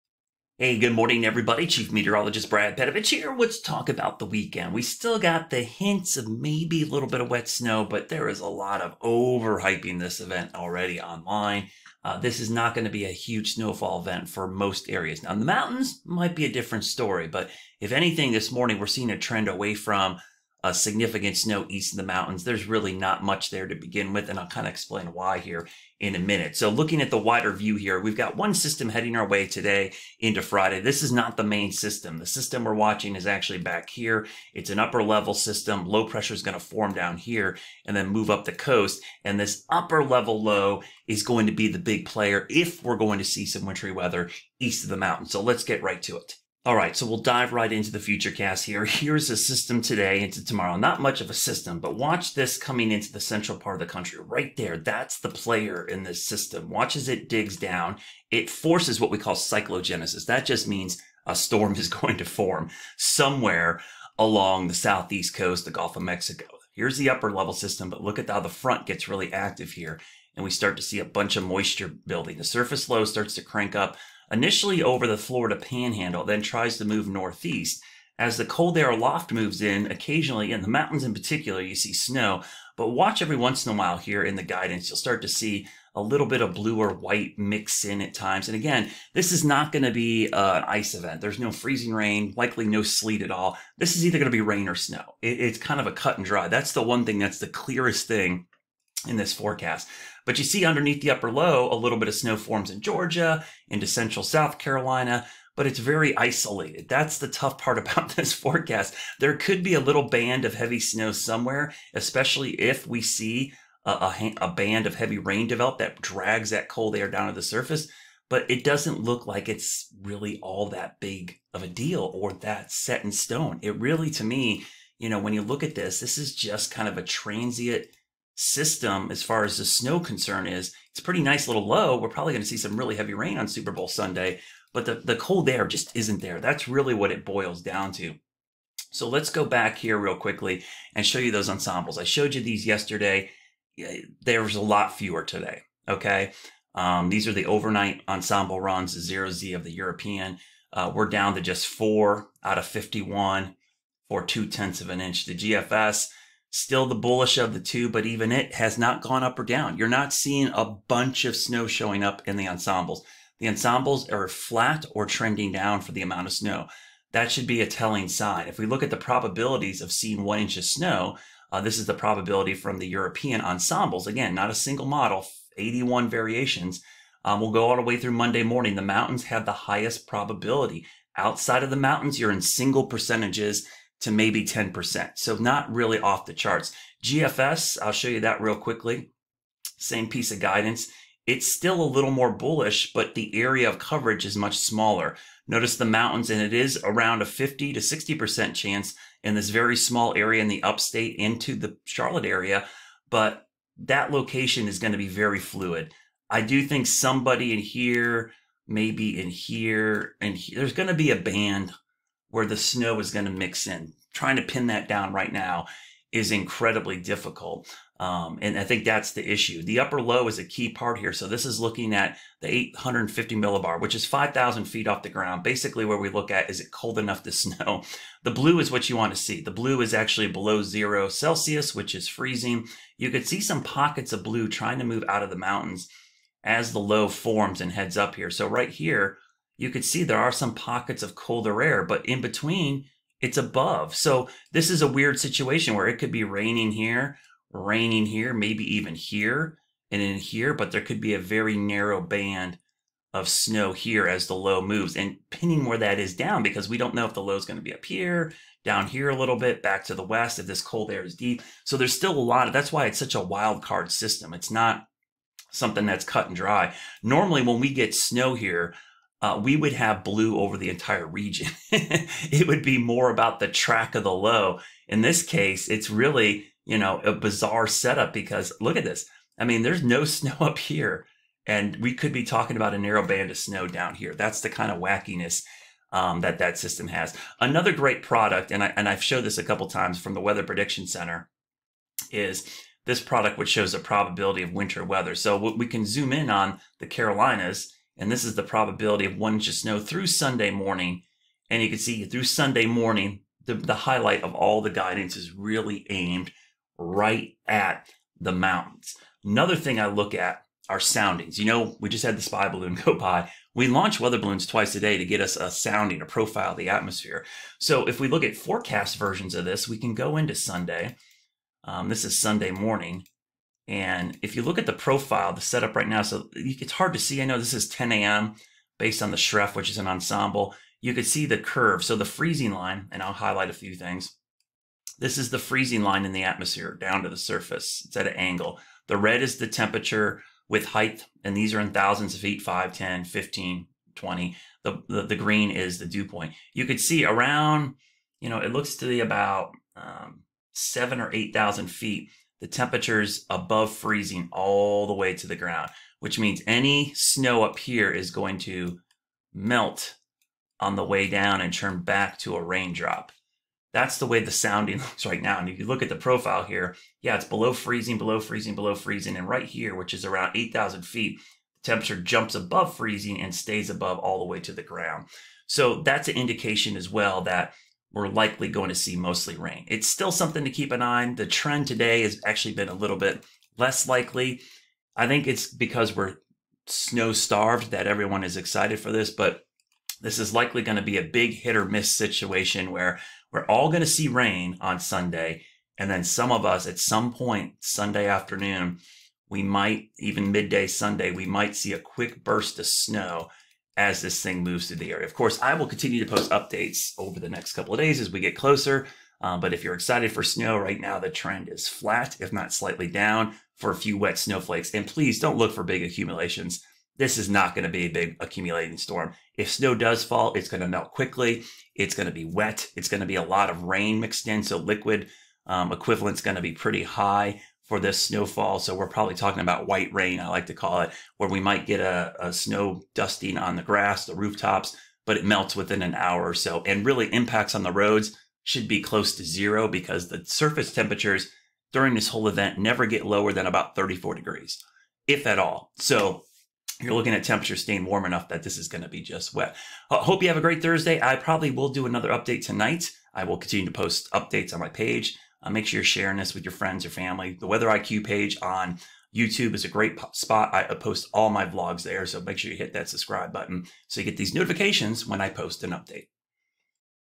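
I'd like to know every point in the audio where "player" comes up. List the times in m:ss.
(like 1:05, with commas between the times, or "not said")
0:42, 0:55.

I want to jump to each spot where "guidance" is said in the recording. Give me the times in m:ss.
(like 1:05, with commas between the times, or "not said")
1:24, 3:10, 5:04.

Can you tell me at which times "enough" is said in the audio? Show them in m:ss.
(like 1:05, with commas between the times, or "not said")
3:46, 7:28.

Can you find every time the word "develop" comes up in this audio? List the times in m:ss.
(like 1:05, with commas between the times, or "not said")
1:55.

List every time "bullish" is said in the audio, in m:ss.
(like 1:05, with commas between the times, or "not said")
2:36, 3:12.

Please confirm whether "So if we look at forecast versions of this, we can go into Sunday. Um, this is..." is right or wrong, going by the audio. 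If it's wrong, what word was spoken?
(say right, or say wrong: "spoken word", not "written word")
right.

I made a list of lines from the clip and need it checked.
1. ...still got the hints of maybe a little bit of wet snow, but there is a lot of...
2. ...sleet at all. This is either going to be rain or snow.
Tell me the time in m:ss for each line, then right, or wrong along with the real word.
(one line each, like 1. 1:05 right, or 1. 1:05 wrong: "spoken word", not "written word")
1. 0:04 right
2. 1:32 right.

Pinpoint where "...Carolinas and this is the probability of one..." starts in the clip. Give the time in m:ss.
4:56.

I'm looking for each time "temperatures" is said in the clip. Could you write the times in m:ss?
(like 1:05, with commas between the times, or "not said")
5:39, 5:52, 6:11, 7:20, 7:27.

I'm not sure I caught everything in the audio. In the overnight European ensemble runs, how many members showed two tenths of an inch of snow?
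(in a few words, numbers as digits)
4 out of 51.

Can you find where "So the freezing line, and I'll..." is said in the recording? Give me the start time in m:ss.
5:31.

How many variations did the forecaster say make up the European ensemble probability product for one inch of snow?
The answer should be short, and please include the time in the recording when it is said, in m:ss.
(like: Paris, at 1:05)
81, at 2:55.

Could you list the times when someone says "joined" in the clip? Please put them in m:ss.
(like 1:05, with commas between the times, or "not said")
not said.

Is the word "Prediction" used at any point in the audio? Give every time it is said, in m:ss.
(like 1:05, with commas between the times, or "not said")
4:50.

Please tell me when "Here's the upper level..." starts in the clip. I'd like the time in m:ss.
1:06.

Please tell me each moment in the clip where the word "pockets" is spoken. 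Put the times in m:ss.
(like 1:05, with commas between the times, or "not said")
3:53, 4:00.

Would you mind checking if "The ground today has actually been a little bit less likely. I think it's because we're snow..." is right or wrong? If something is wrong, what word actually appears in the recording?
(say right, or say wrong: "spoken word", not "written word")
wrong: "trend", not "ground".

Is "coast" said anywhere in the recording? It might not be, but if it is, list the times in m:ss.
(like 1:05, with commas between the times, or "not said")
0:38, 1:05.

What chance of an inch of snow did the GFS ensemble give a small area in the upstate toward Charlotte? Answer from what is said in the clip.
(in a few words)
50 to 60%.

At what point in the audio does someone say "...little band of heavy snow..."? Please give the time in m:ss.
1:49.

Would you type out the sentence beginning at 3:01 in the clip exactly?
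Outside of the mountains, you're in single percentages to maybe 10%.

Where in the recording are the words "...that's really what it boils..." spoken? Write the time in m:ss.
2:16.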